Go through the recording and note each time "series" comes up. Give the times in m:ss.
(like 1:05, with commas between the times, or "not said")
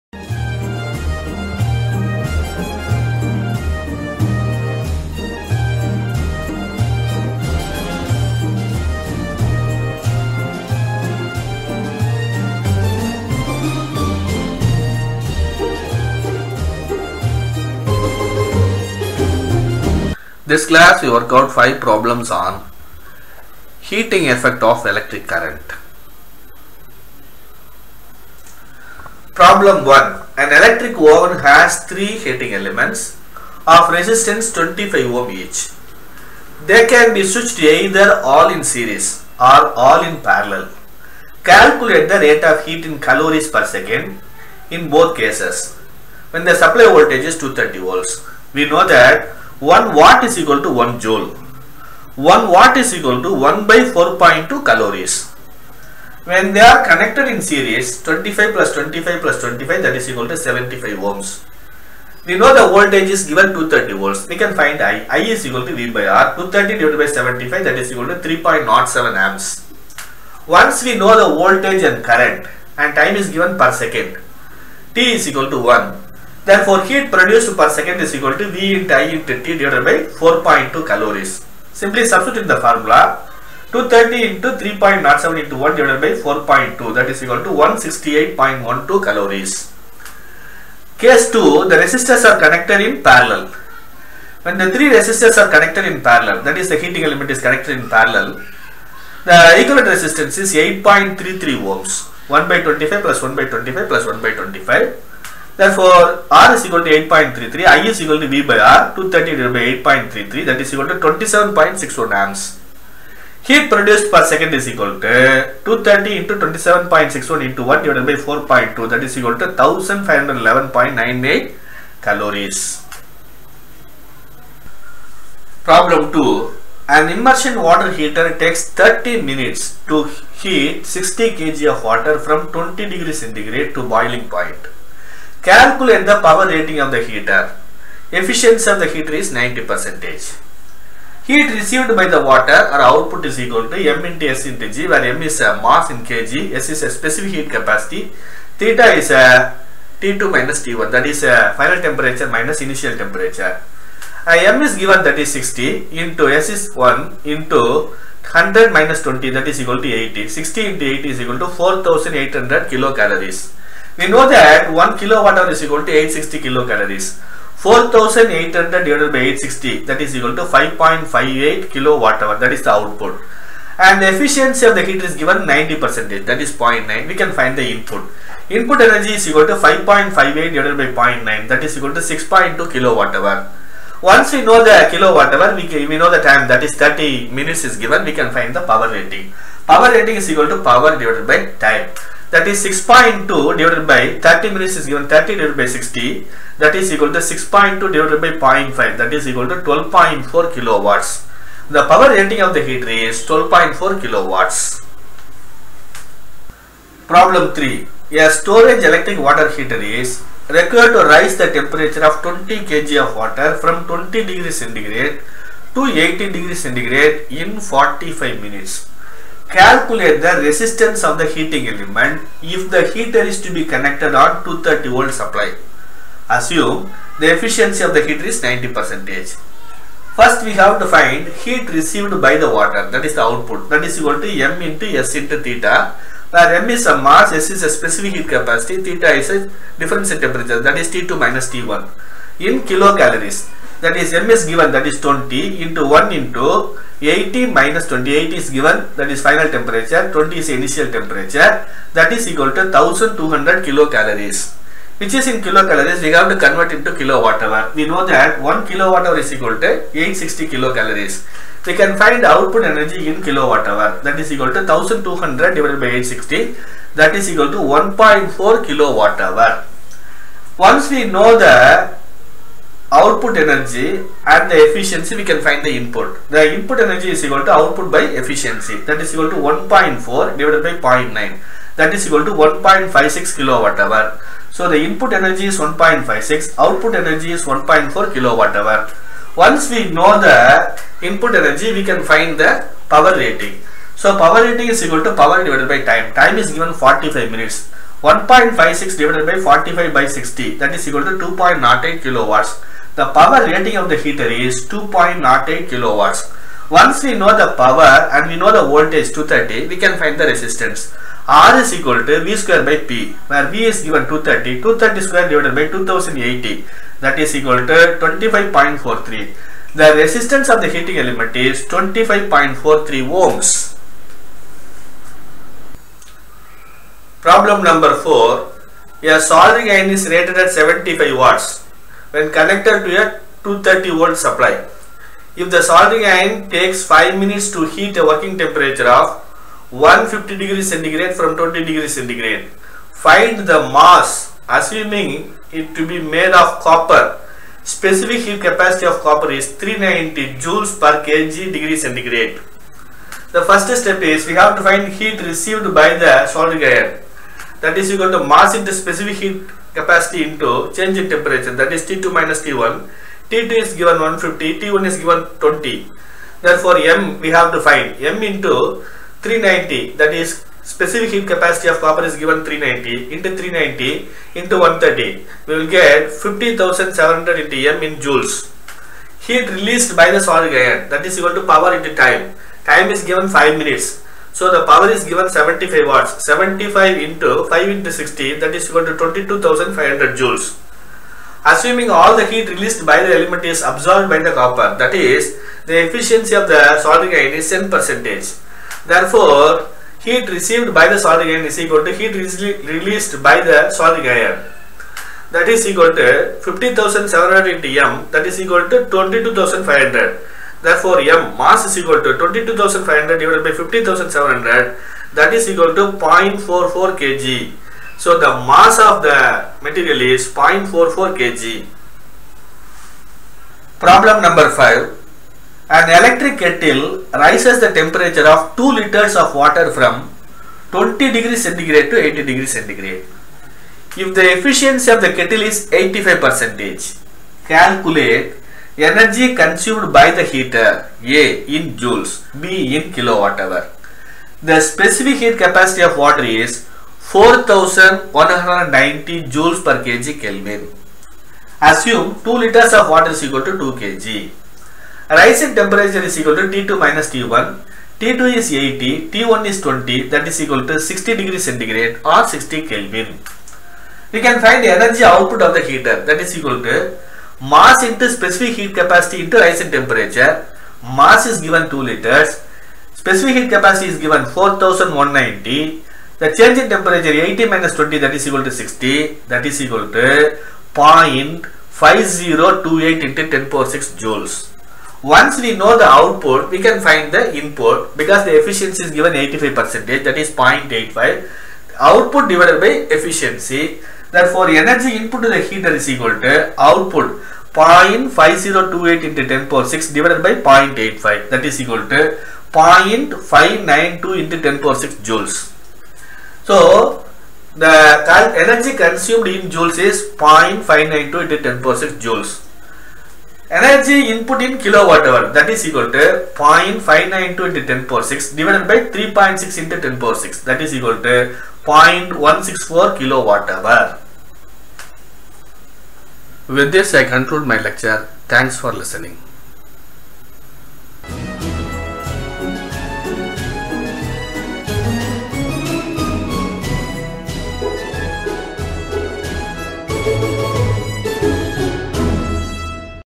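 0:38, 0:57.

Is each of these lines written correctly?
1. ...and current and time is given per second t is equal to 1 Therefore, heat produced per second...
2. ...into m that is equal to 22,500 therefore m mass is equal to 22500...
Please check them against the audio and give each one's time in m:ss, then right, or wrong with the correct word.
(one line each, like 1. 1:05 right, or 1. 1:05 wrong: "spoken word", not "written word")
1. 1:11 right
2. 6:47 right.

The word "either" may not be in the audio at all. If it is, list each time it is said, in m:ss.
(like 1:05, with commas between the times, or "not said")
0:37.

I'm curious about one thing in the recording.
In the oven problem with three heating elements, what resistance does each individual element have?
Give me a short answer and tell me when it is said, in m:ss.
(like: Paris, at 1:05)
25 ohm, at 0:34.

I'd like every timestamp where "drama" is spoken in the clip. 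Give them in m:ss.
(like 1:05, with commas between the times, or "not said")
not said.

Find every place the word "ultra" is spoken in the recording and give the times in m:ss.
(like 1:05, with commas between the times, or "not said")
not said.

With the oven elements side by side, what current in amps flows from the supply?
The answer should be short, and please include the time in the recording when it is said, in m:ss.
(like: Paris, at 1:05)
27.61 amps, at 1:50.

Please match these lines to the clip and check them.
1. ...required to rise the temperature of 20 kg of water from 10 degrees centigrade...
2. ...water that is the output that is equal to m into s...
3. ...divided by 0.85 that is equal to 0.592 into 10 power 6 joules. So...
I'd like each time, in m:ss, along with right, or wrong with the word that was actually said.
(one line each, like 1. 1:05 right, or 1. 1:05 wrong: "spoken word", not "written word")
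1. 3:30 wrong: "20", not "10"
2. 3:52 right
3. 8:19 right.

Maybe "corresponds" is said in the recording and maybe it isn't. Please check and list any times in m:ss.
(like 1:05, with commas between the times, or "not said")
not said.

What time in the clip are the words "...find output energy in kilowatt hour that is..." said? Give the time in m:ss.
4:22.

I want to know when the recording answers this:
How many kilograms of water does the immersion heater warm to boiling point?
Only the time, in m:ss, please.
2:10.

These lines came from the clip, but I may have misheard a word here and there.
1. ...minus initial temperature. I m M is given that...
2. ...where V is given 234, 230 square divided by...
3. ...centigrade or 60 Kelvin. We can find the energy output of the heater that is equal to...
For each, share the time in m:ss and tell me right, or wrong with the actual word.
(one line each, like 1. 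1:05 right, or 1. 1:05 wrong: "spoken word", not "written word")
1. 2:32 right
2. 5:13 wrong: "230", not "234"
3. 7:41 right.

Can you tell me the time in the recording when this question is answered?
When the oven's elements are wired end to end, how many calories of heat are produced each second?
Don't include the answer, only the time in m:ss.
1:27.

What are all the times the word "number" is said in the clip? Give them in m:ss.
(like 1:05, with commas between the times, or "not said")
5:27, 7:04.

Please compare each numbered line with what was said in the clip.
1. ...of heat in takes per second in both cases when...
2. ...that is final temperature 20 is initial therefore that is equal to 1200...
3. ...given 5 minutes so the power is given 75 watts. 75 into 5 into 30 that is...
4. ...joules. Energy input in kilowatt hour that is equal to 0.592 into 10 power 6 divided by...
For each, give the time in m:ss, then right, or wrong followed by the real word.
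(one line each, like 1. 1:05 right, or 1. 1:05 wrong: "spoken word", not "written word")
1. 0:42 wrong: "calories", not "takes"
2. 4:08 wrong: "temperature", not "therefore"
3. 6:23 wrong: "60", not "30"
4. 8:32 right.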